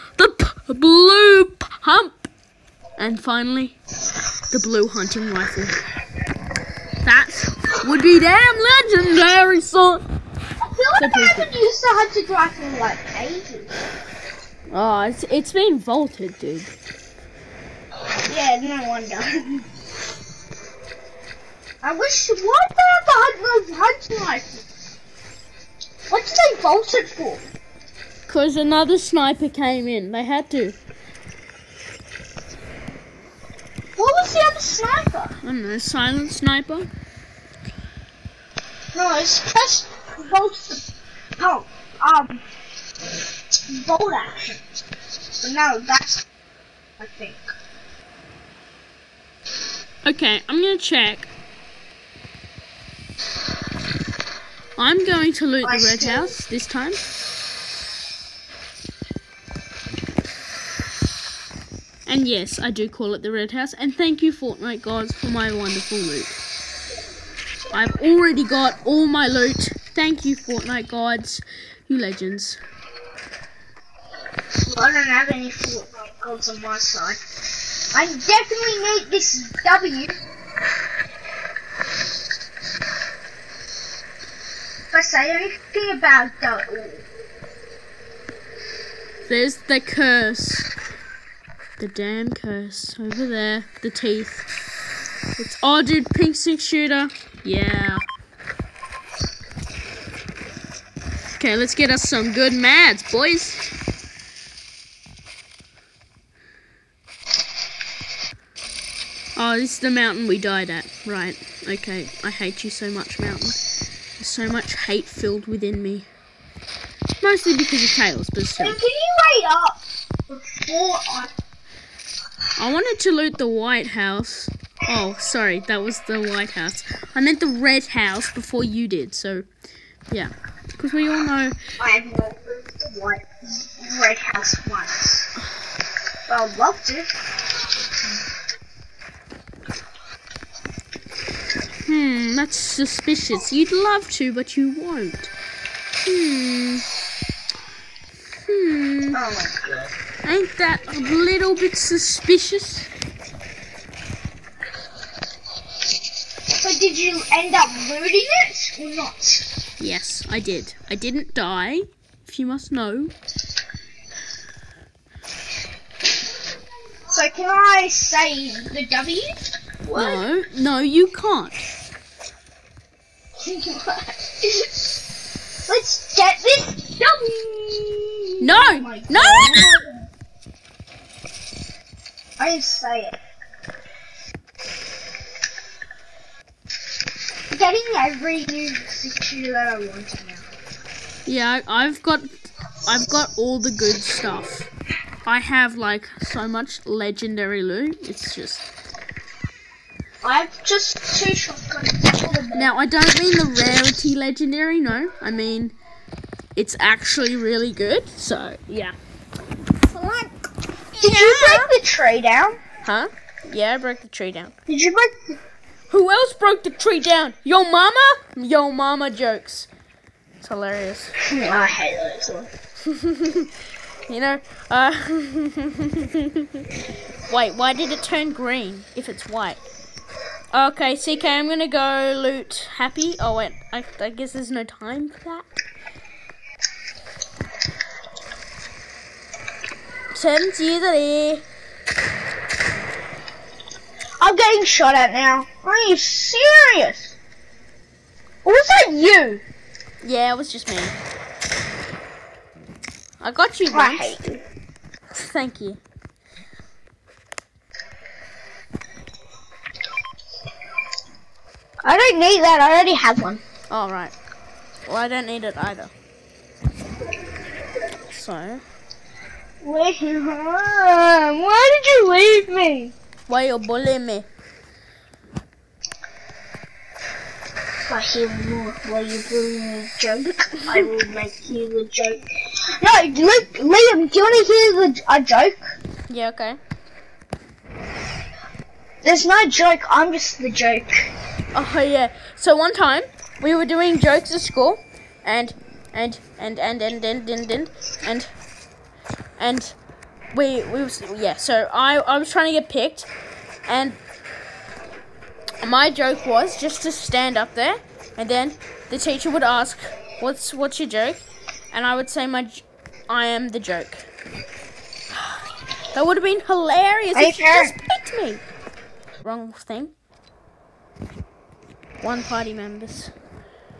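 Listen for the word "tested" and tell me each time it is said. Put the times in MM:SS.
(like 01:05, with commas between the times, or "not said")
not said.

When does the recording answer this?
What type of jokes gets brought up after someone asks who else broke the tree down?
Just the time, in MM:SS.
03:38.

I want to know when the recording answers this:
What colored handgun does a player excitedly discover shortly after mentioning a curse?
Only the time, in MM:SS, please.
01:36.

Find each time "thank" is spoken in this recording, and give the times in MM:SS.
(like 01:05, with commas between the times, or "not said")
01:03, 01:09, 04:15.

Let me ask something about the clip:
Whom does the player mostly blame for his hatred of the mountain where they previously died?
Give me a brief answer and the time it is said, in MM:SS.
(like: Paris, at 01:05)
Tails, at 01:57.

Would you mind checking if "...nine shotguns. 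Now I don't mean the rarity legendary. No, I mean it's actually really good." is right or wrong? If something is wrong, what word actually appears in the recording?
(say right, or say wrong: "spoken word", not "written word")
wrong: "two", not "nine".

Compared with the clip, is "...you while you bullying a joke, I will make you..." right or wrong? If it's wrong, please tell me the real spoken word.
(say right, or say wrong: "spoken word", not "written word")
right.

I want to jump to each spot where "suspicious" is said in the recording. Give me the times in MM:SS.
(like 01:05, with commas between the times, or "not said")
02:22, 02:31.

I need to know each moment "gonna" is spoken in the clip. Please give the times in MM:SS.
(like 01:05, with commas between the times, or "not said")
00:50, 03:51.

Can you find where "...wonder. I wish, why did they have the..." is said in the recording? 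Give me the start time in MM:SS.
00:18.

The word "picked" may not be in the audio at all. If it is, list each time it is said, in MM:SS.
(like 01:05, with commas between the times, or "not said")
05:02, 05:17.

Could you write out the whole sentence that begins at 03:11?
Yeah, I've got, I've got all the good stuff.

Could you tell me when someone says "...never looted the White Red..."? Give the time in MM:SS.
02:12.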